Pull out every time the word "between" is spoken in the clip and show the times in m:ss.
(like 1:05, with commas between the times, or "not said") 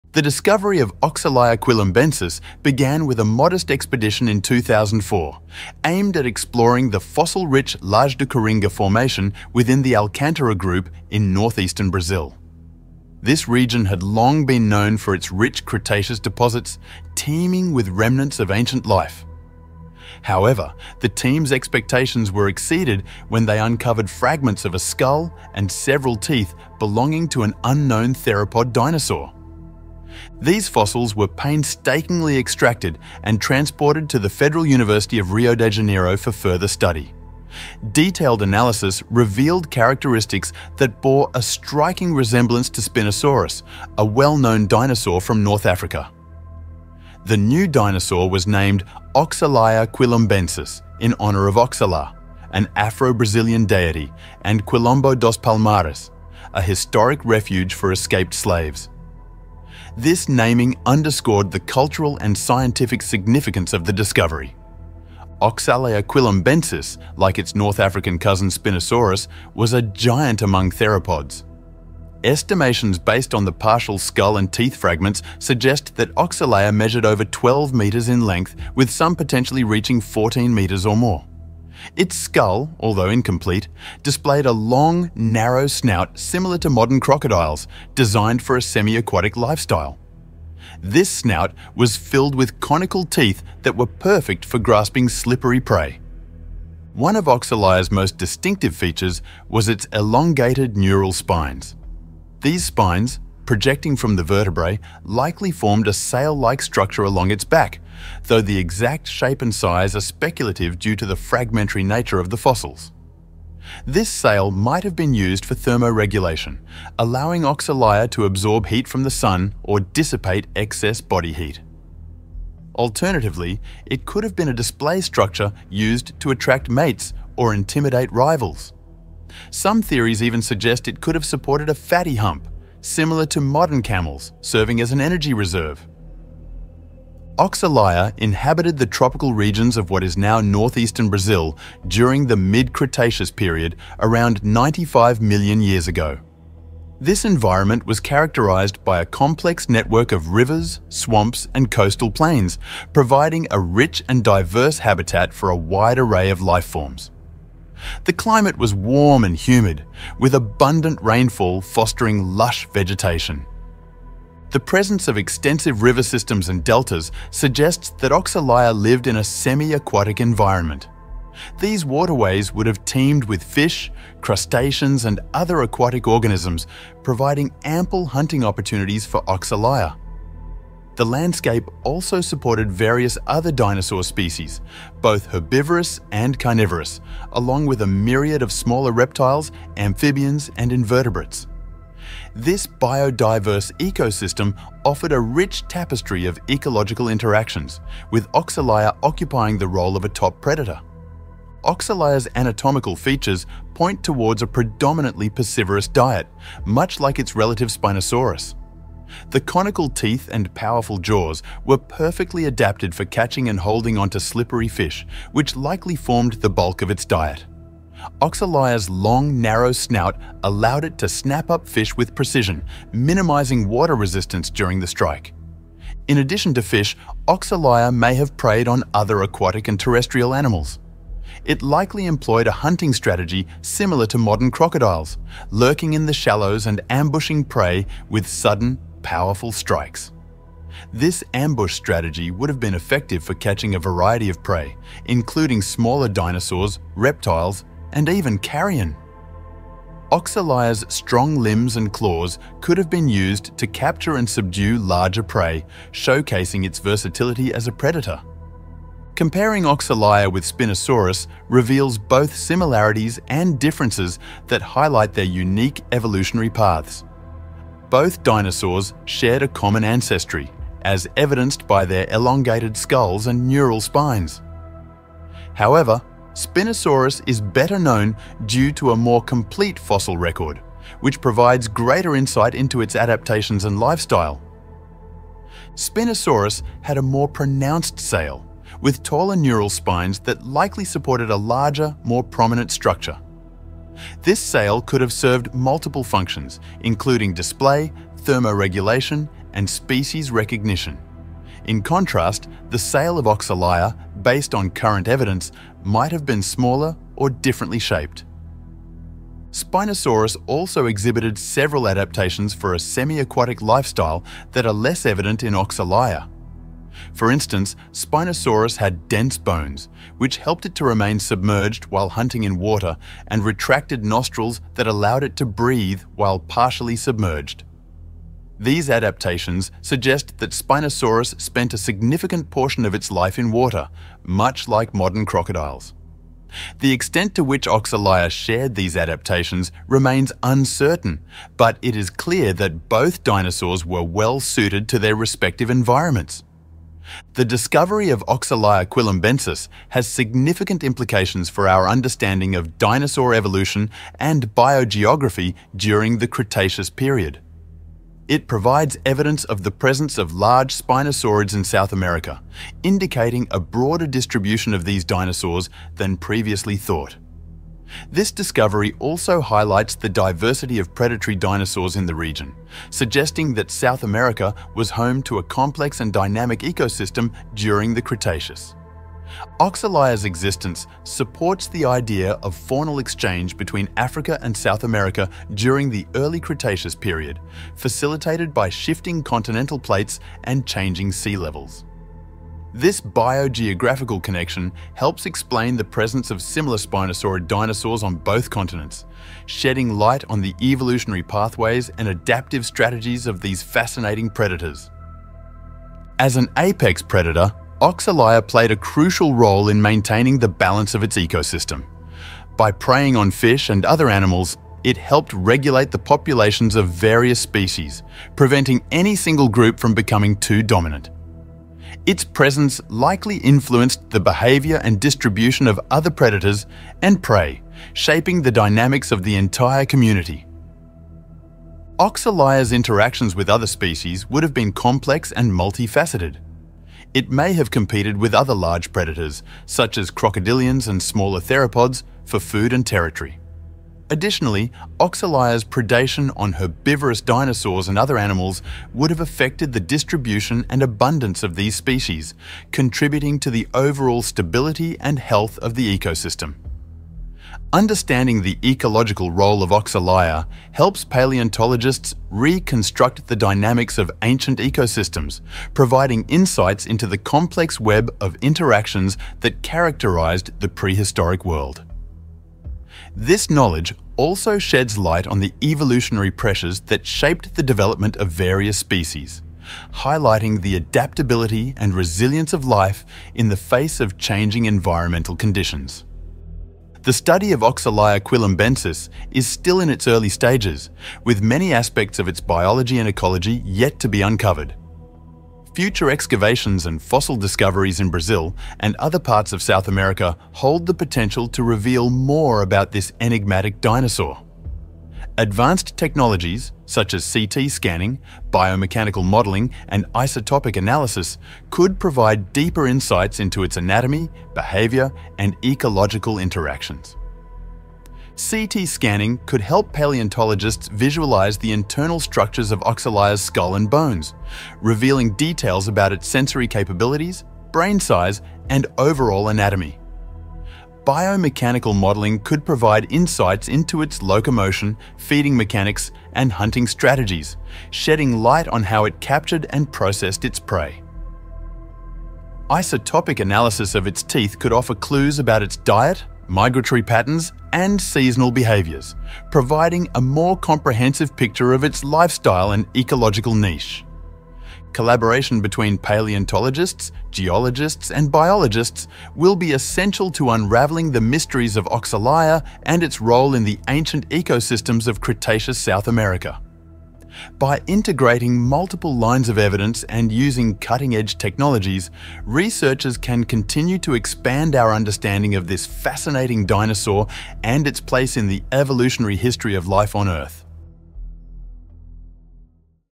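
6:23, 9:15.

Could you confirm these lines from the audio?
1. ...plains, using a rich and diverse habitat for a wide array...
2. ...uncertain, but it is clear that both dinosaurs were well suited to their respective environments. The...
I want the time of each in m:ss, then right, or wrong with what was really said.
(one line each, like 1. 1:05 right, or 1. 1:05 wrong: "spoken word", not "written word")
1. 2:32 wrong: "providing", not "using"
2. 5:40 right.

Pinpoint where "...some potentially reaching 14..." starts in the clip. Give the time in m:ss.
1:18.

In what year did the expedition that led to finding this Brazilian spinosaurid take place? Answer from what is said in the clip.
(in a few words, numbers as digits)
2004.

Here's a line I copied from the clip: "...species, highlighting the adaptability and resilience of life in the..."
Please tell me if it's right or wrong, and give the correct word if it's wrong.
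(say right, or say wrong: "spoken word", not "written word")
right.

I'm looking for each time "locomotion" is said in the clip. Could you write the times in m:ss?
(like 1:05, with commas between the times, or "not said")
8:54.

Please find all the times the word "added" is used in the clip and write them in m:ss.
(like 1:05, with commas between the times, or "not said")
not said.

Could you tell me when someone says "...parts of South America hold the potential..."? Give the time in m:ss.
8:19.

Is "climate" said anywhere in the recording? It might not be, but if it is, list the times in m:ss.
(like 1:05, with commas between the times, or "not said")
2:38.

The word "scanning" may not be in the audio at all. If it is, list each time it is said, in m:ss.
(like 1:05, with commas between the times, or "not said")
8:27, 8:38.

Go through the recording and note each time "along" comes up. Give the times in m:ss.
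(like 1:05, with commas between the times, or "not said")
1:47, 3:07.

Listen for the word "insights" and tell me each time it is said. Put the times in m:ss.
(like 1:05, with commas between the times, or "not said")
4:42, 7:46, 8:32, 8:53.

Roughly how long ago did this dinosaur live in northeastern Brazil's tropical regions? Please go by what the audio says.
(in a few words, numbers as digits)
95 million years.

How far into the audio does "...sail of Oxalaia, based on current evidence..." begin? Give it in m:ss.
5:02.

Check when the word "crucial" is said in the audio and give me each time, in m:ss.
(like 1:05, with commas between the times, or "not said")
6:48.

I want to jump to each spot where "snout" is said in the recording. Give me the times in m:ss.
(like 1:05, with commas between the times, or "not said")
1:25, 1:31, 3:39.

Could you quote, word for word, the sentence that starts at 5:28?
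These adaptations suggest that Spinosaurus spent a significant portion of its life in water, much like modern crocodiles.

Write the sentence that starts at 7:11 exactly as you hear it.
Oxalaia's interactions with other species would have been complex and multifaceted.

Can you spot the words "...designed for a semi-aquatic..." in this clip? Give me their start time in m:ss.
1:27.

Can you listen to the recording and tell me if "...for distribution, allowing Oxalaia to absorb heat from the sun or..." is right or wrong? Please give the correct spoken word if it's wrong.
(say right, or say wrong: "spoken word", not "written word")
wrong: "thermoregulation", not "distribution".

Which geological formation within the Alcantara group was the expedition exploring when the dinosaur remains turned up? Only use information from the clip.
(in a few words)
Laje de Coringa.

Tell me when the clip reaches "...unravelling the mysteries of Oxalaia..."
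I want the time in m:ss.
9:20.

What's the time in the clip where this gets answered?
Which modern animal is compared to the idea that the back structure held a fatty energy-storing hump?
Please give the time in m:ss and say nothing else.
2:13.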